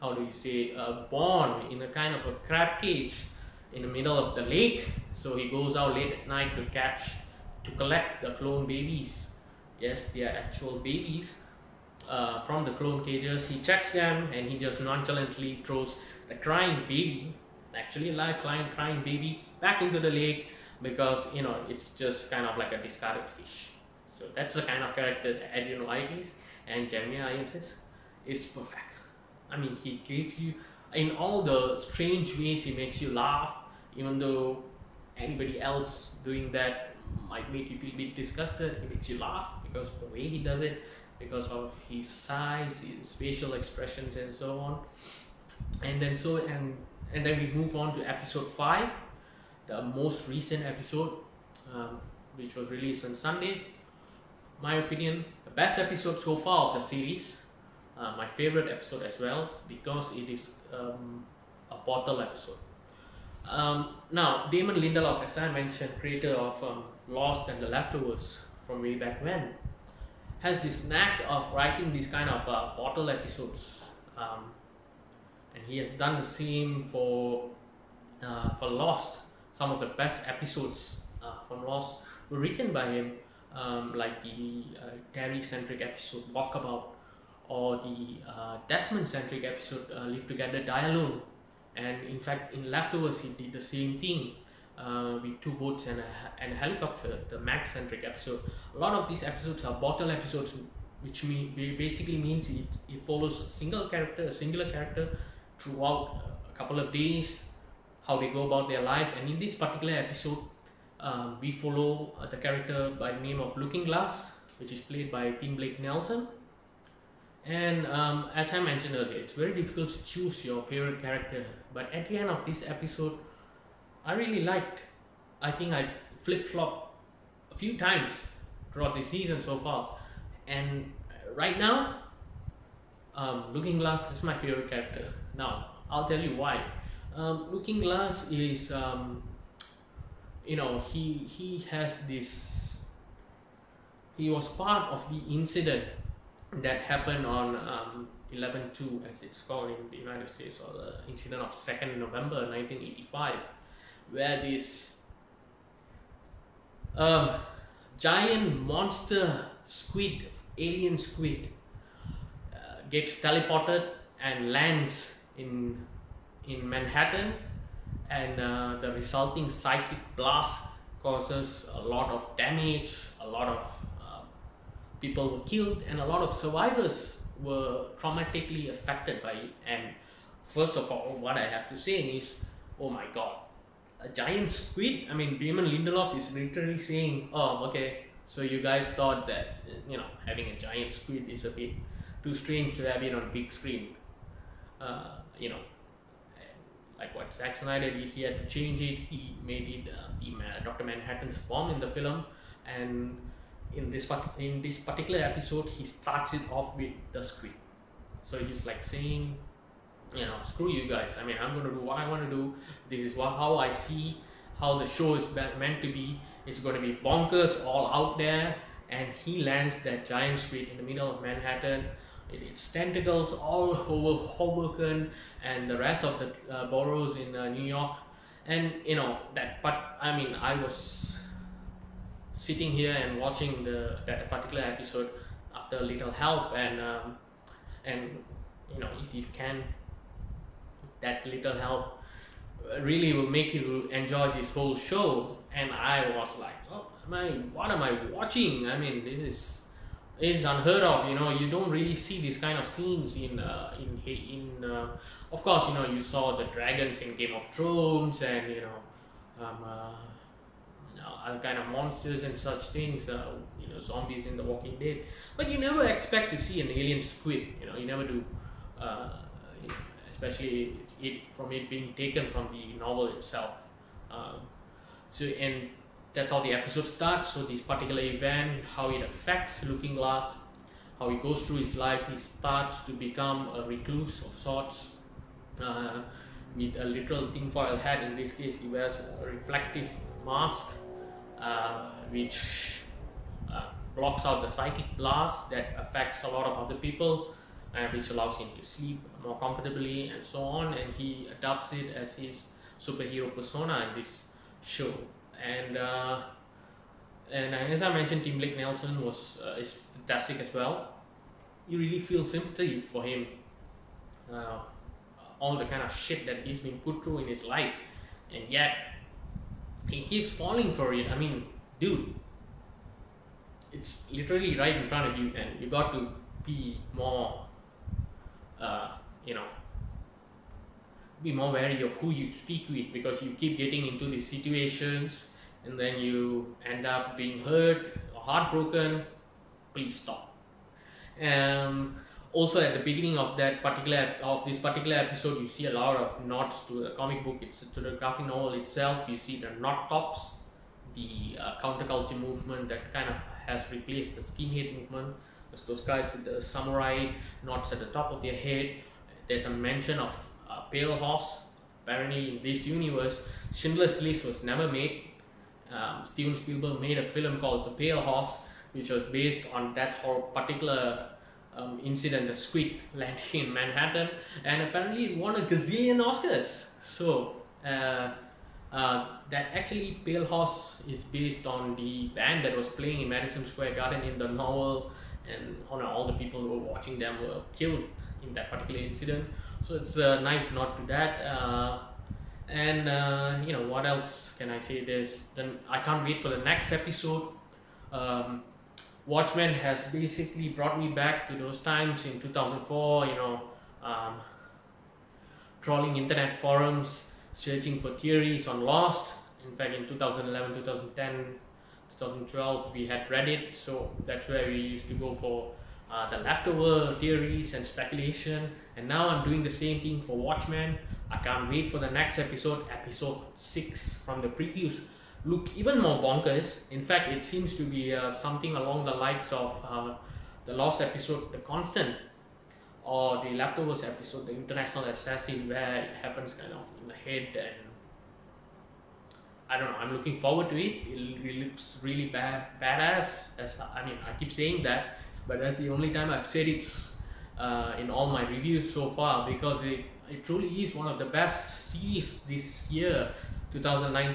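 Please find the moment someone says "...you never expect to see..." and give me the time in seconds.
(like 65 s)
265 s.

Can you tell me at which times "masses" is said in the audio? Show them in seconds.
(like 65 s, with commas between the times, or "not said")
not said.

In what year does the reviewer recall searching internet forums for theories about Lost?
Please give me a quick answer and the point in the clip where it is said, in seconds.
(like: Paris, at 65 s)
2004, at 402 s.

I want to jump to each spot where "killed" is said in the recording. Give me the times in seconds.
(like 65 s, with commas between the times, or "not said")
175 s, 387 s.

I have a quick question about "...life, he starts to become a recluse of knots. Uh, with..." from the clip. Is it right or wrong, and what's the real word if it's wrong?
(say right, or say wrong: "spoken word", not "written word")
wrong: "sorts", not "knots".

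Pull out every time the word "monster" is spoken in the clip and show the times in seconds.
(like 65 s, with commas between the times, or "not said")
158 s, 261 s.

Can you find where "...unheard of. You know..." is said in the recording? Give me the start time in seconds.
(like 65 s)
250 s.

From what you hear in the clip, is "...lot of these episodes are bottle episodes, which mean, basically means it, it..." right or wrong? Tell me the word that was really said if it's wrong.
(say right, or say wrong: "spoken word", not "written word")
right.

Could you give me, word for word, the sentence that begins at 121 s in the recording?
But at the end of this episode, I really liked.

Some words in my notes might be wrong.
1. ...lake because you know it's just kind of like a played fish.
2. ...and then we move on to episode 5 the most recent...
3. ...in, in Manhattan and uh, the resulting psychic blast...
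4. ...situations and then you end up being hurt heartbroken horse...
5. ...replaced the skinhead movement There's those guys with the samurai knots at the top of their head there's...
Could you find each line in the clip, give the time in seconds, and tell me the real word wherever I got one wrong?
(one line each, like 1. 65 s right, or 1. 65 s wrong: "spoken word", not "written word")
1. 20 s wrong: "discarded", not "played"
2. 47 s right
3. 165 s right
4. 334 s wrong: "please", not "horse"
5. 353 s right.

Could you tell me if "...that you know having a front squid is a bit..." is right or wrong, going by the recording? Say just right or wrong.
wrong.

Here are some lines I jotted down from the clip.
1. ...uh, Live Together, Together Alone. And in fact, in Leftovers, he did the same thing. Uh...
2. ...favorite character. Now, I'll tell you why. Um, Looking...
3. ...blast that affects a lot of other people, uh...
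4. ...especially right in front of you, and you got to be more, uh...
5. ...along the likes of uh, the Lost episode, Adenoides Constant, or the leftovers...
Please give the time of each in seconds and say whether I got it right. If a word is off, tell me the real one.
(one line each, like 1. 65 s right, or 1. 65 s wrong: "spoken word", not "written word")
1. 89 s wrong: "Die", not "Together"
2. 134 s right
3. 294 s right
4. 324 s wrong: "literally", not "especially"
5. 428 s wrong: "The", not "Adenoides".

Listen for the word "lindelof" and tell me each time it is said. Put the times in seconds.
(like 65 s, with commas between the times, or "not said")
64 s, 185 s.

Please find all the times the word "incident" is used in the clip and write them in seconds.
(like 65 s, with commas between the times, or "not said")
145 s, 151 s, 371 s, 388 s.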